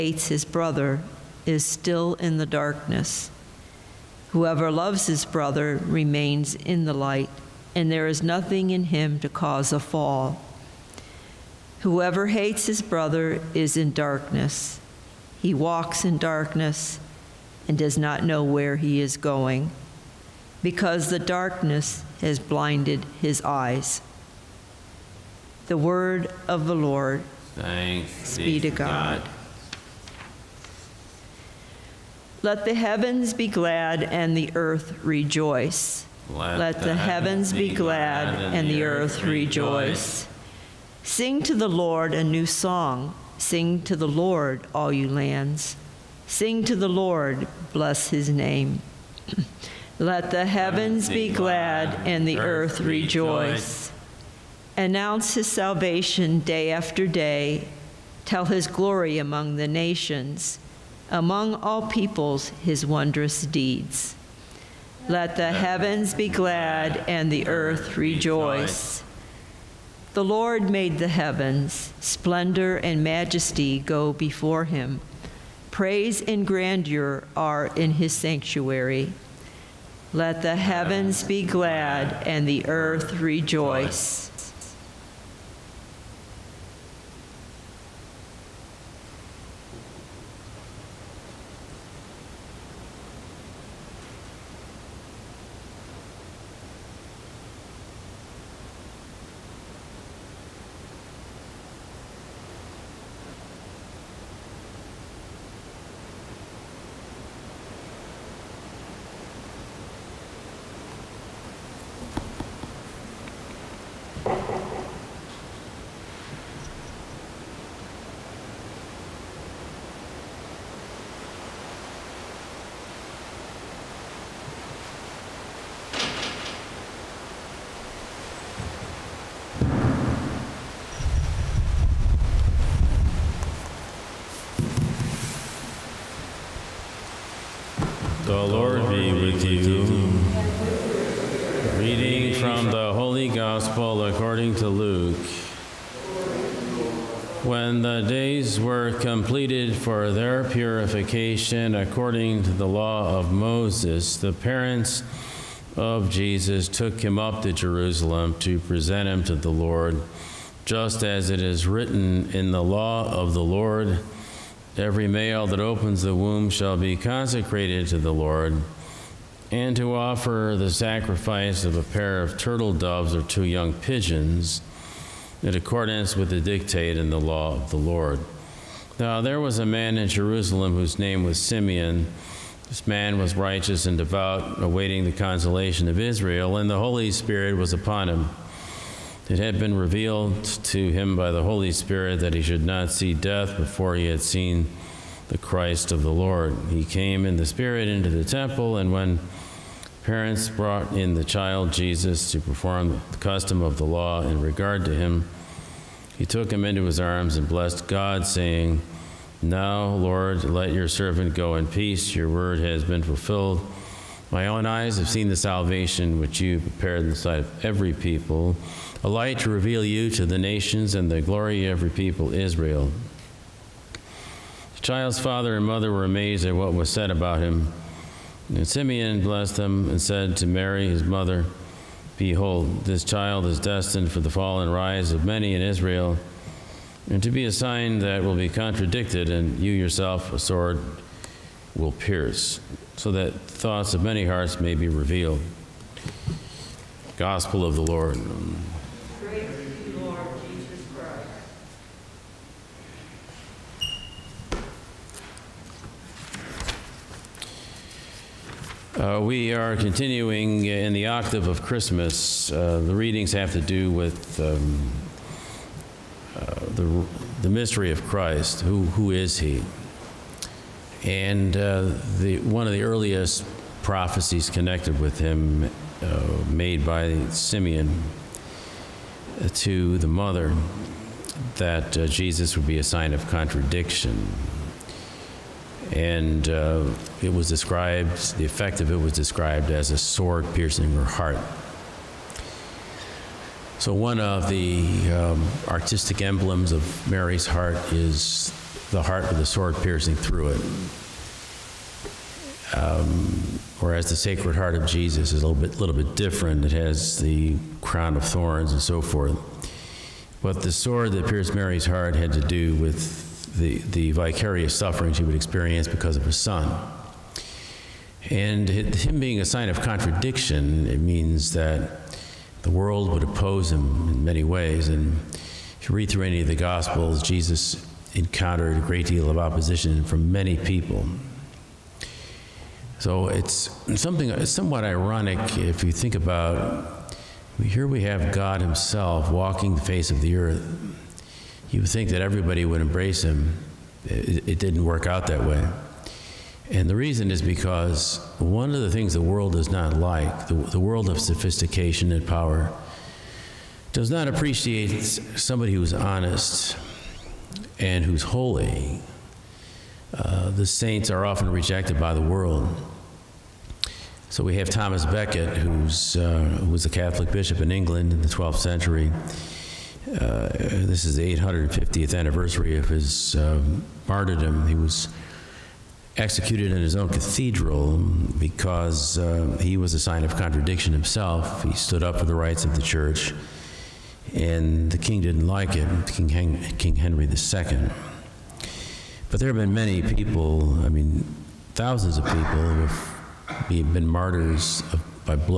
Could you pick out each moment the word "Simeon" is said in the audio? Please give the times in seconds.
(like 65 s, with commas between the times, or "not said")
181 s, 228 s, 277 s.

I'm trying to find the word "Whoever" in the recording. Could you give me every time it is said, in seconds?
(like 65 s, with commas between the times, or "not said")
4 s, 11 s.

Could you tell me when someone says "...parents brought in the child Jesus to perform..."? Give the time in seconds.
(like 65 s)
200 s.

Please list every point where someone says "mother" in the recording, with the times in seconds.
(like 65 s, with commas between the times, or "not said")
225 s, 231 s, 280 s.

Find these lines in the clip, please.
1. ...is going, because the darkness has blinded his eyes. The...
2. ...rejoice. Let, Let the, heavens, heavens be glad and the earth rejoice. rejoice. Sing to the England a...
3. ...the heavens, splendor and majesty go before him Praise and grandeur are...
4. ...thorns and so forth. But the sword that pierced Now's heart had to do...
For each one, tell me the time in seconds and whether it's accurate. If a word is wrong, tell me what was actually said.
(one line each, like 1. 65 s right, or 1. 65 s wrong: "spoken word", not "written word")
1. 18 s right
2. 35 s wrong: "Lord", not "England"
3. 70 s right
4. 308 s wrong: "Mary", not "Now".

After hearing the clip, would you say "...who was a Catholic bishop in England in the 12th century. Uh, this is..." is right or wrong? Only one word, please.
right.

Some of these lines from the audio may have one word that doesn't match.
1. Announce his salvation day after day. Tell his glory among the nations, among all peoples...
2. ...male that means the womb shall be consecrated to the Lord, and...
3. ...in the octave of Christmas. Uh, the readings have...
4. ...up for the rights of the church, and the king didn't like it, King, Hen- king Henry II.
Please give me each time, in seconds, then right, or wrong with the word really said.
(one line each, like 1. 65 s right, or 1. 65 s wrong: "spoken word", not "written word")
1. 54 s right
2. 165 s wrong: "opens", not "means"
3. 260 s right
4. 382 s right.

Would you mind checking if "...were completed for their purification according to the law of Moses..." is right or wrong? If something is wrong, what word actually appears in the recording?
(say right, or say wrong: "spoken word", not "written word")
right.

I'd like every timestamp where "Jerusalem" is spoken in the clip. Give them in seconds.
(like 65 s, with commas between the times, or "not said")
157 s, 180 s.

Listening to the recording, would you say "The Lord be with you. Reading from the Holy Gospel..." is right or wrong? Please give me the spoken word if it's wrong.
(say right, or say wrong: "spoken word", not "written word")
right.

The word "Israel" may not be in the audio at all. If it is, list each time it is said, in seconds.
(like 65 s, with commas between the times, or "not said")
185 s, 222 s, 235 s.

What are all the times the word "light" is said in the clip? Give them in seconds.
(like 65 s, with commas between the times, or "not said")
6 s, 219 s.